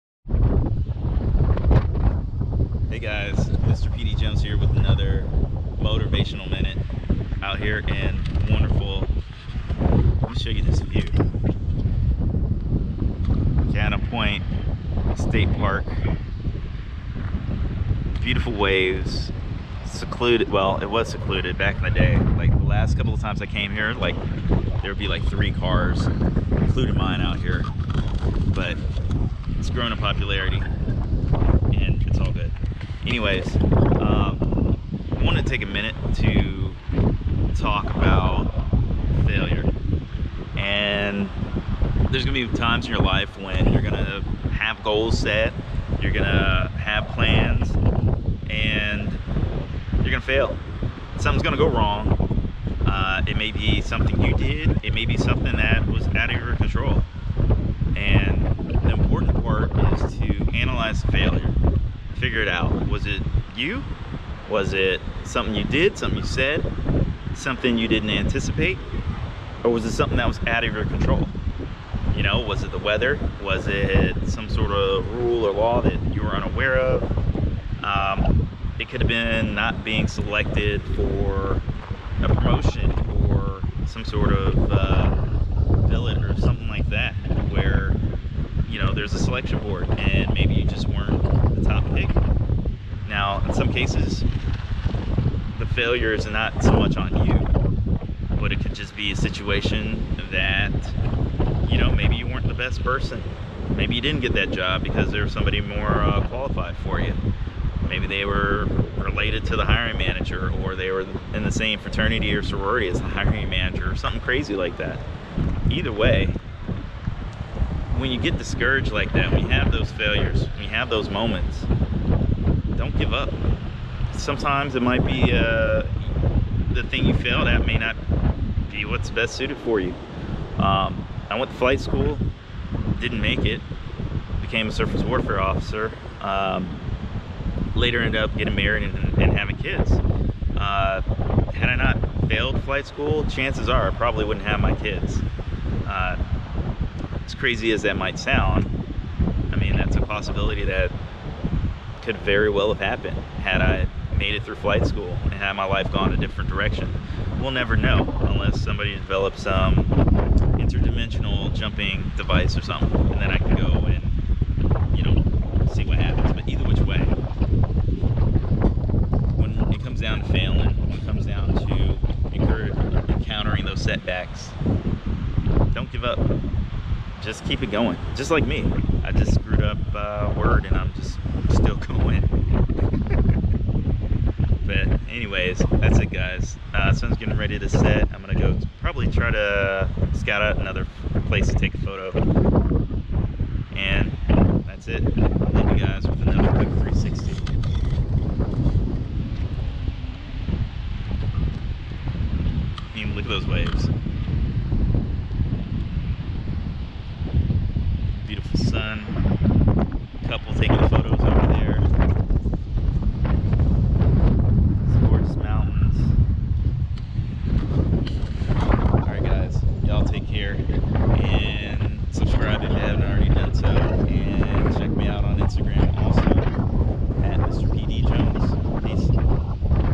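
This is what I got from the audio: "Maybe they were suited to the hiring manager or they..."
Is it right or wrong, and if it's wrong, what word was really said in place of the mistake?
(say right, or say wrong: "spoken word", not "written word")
wrong: "related", not "suited".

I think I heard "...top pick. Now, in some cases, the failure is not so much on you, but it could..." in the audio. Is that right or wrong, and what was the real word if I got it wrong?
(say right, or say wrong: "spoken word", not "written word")
right.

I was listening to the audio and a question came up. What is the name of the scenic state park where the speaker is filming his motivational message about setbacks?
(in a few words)
Kaena Point State Park.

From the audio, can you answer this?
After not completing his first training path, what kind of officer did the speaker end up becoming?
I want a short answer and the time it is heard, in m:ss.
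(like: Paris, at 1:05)
surface warfare officer, at 2:14.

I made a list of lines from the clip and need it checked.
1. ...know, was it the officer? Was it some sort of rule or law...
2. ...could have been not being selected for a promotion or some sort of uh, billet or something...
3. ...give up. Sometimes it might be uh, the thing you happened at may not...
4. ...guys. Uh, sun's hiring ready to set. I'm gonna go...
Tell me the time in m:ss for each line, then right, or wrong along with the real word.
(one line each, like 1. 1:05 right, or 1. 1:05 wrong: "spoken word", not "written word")
1. 1:12 wrong: "weather", not "officer"
2. 1:18 right
3. 2:03 wrong: "failed", not "happened"
4. 3:06 wrong: "getting", not "hiring".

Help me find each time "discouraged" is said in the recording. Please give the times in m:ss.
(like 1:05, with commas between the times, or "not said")
1:58.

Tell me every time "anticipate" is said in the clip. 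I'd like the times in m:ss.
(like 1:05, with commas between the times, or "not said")
1:08.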